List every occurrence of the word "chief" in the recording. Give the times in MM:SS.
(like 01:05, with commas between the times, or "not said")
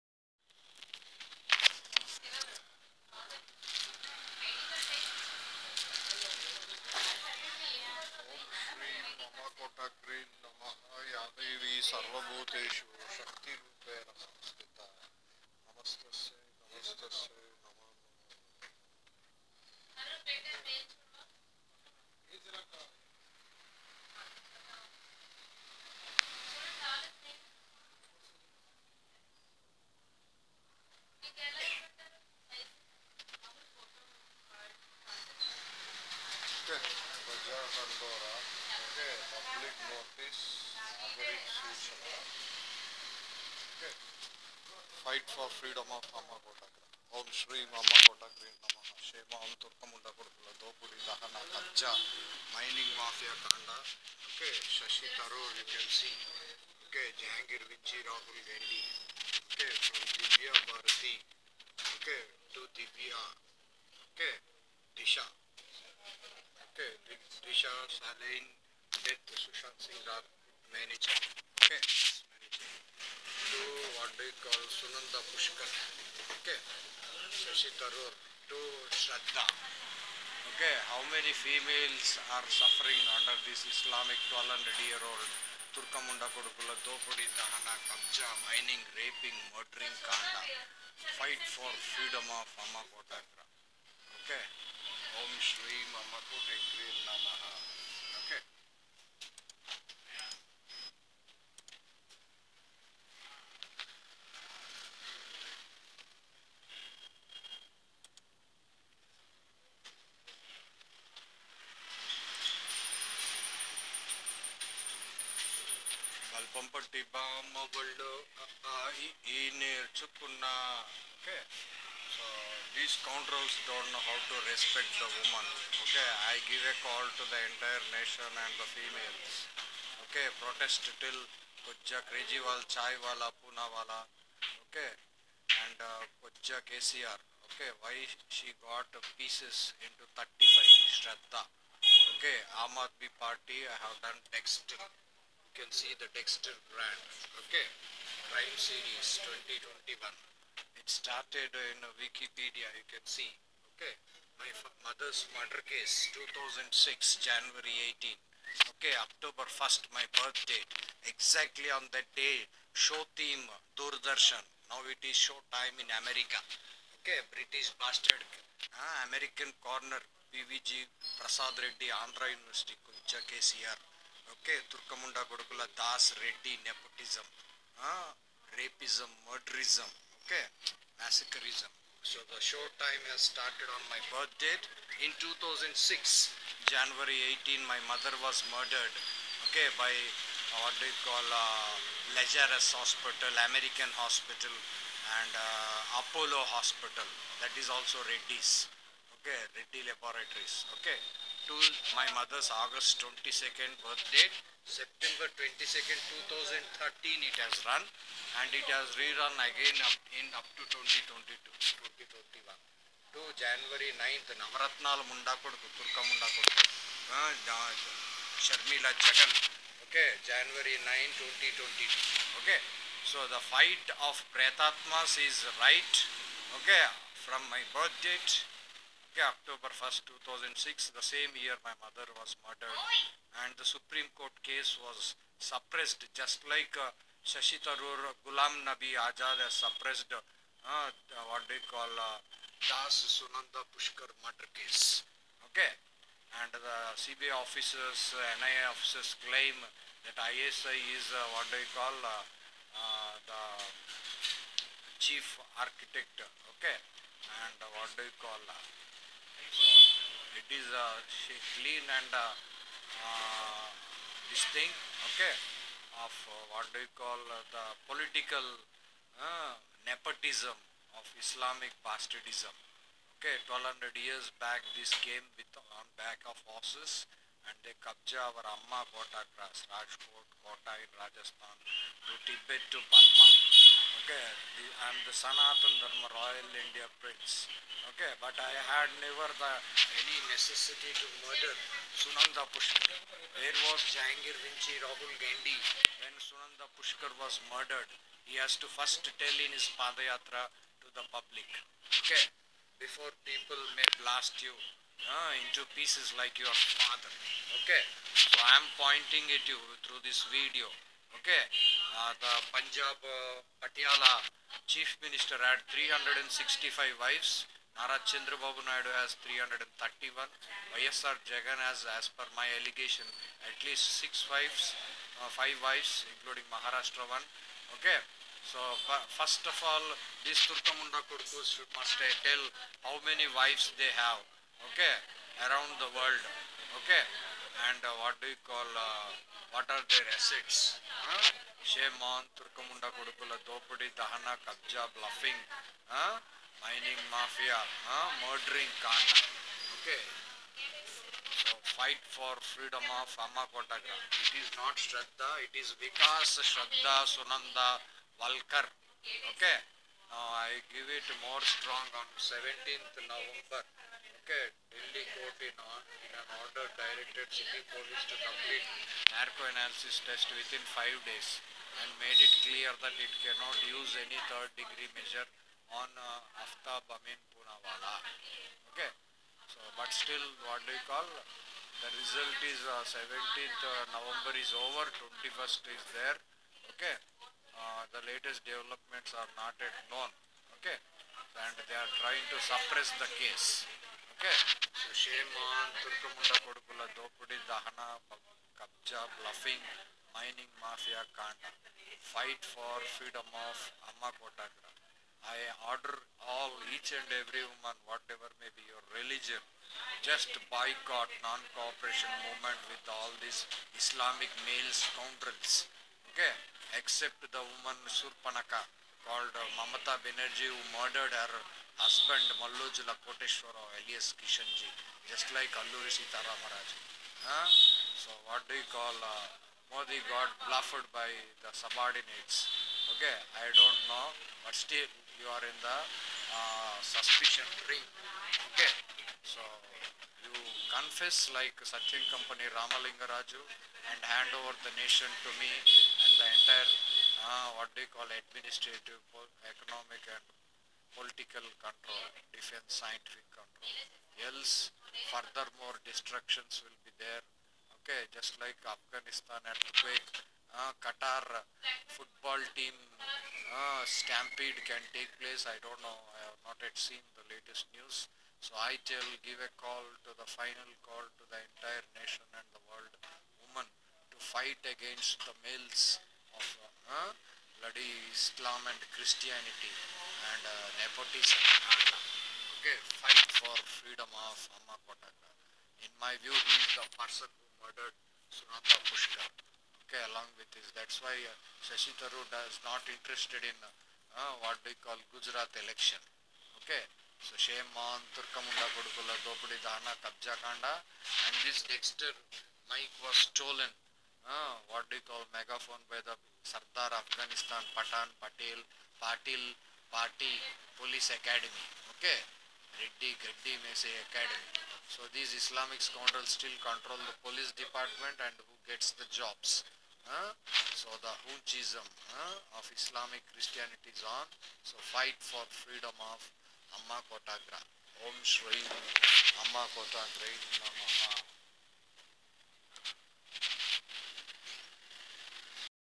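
04:15, 05:14.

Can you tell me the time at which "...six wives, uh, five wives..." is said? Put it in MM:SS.
05:23.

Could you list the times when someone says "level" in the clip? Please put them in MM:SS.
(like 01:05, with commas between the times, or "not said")
not said.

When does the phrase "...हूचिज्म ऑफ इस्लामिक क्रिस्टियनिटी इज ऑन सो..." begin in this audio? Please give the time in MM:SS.
08:41.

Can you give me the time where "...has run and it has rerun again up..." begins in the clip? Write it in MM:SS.
03:27.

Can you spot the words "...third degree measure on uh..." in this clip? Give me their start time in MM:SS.
06:14.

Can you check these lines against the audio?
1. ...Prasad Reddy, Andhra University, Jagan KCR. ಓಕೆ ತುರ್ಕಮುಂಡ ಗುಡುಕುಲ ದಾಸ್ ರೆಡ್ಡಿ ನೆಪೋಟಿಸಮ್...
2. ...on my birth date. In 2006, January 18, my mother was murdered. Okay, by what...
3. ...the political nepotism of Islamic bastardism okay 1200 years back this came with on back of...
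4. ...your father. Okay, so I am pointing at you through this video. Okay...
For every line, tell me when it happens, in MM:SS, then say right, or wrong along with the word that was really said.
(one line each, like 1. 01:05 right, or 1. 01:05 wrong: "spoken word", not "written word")
1. 02:51 wrong: "Kuncha", not "Jagan"
2. 03:03 right
3. 04:27 right
4. 05:06 right.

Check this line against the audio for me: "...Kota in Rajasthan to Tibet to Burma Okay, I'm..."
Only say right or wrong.
right.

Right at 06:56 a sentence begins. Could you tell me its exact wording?
Okay, except the woman Surpanaka called Mamata Benerji who murdered her, husband Mallojula Koteshwara alias Kishanji, just like Alluri Sitara Maharaj.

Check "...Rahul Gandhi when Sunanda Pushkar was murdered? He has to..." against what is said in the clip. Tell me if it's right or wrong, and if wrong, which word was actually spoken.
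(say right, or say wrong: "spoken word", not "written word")
right.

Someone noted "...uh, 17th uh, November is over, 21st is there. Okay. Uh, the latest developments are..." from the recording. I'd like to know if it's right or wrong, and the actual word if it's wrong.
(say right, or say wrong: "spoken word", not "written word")
right.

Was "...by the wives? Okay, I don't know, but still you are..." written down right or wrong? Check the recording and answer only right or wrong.
wrong.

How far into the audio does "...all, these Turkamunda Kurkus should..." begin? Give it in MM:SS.
05:29.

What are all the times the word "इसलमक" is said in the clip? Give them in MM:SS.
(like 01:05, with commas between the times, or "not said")
08:35, 08:42.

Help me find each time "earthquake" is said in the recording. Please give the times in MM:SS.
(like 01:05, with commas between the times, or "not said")
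07:39.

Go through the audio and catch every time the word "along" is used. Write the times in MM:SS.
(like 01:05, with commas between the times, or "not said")
08:10.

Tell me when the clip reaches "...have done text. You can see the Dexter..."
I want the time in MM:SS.
02:23.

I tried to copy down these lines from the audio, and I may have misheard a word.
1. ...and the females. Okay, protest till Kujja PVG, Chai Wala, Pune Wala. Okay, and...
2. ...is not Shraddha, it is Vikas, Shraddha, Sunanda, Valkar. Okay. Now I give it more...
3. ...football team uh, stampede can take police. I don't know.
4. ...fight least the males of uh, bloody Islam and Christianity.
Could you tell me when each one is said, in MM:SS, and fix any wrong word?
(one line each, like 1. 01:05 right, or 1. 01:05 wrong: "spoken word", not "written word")
1. 02:08 wrong: "Kejriwal", not "PVG"
2. 05:54 right
3. 07:41 wrong: "place", not "police"
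4. 07:54 wrong: "against", not "least".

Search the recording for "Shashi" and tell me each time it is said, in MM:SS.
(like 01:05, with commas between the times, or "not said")
00:54, 01:17, 03:57, 08:11.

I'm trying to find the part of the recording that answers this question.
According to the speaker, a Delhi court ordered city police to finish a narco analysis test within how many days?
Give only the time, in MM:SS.
06:10.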